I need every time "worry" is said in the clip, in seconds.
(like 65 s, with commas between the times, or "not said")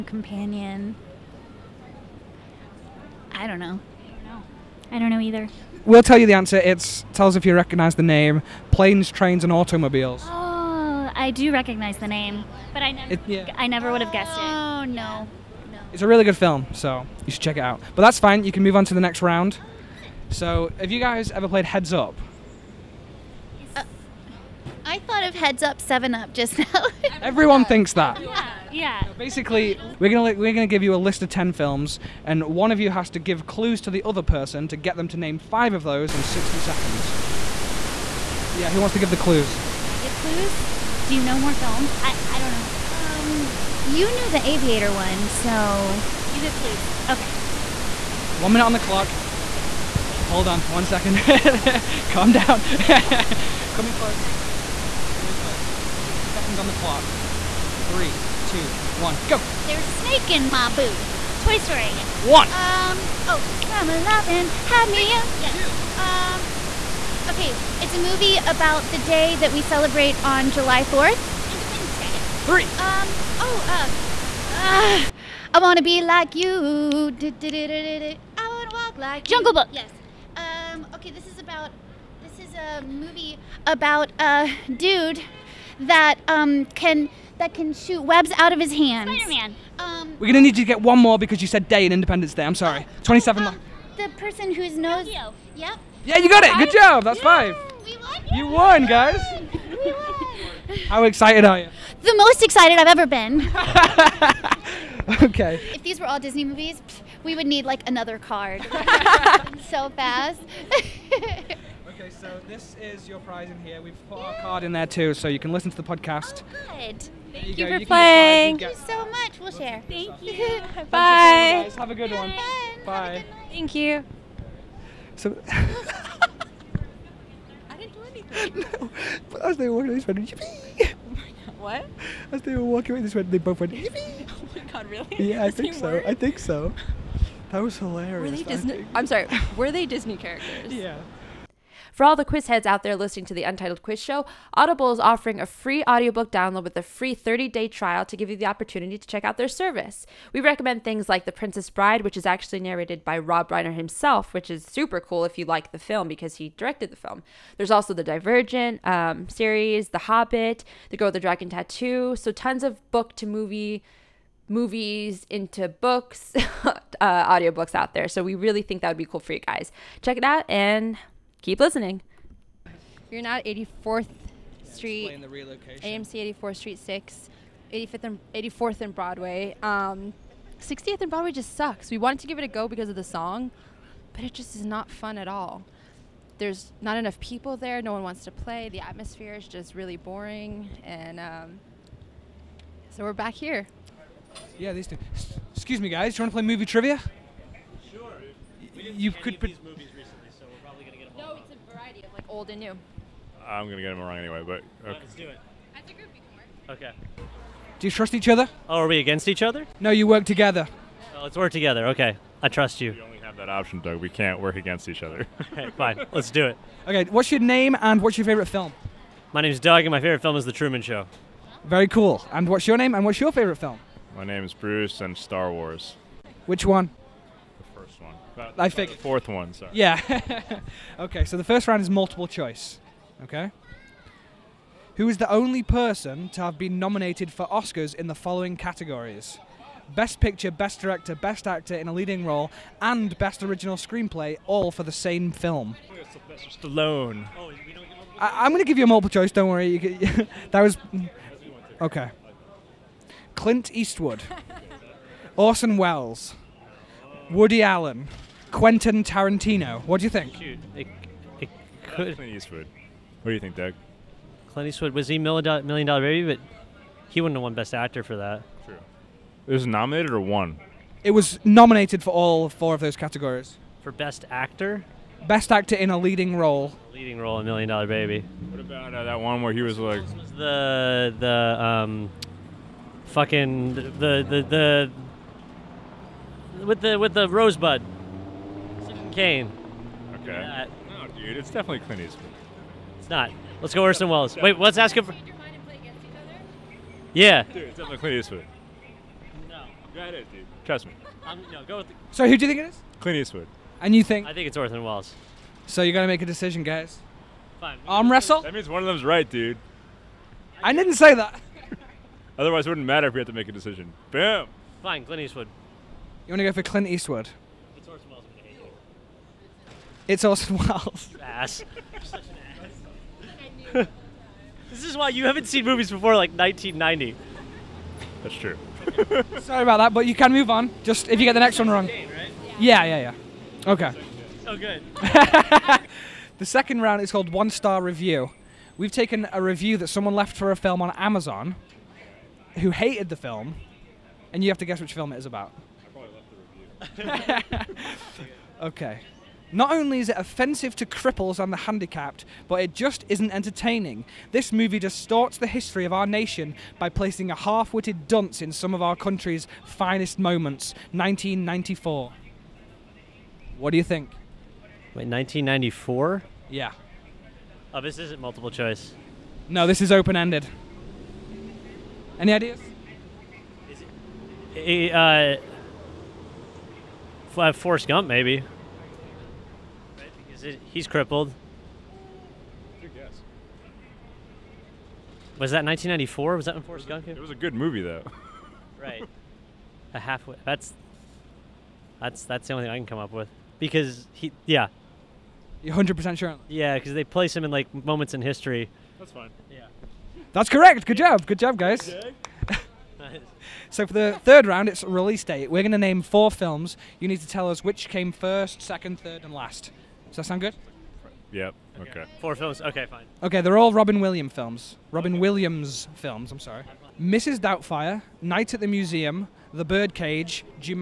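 249 s.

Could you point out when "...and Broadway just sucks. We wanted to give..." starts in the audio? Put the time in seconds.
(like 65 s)
180 s.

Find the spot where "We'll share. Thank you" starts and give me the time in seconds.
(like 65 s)
119 s.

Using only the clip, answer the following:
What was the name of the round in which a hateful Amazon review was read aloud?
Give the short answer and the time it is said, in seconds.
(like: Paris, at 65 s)
One Star Review, at 337 s.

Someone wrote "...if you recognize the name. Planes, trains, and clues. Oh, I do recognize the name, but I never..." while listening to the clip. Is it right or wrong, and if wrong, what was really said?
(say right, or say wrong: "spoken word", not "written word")
wrong: "automobiles", not "clues".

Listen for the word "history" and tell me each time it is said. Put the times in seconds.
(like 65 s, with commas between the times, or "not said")
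355 s, 398 s.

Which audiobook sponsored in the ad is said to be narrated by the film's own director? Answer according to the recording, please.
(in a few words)
The Princess Bride.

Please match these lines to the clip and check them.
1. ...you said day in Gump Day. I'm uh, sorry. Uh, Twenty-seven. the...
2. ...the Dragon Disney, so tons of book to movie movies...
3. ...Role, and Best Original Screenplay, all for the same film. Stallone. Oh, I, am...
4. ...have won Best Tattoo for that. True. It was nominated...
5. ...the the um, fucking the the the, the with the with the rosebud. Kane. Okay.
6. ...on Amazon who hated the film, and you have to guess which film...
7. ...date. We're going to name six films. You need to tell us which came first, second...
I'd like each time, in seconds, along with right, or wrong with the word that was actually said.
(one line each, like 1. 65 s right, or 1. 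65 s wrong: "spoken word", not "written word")
1. 91 s wrong: "Independence", not "Gump"
2. 161 s wrong: "Tattoo", not "Disney"
3. 242 s right
4. 267 s wrong: "Actor", not "Tattoo"
5. 280 s right
6. 340 s right
7. 405 s wrong: "four", not "six".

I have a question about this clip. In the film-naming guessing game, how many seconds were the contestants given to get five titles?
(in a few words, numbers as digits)
60.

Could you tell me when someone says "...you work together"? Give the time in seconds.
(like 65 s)
209 s.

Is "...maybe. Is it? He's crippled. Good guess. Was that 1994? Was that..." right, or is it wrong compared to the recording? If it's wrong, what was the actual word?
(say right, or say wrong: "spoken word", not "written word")
right.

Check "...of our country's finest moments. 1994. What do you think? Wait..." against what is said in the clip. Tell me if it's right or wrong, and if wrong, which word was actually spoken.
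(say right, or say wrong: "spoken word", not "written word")
right.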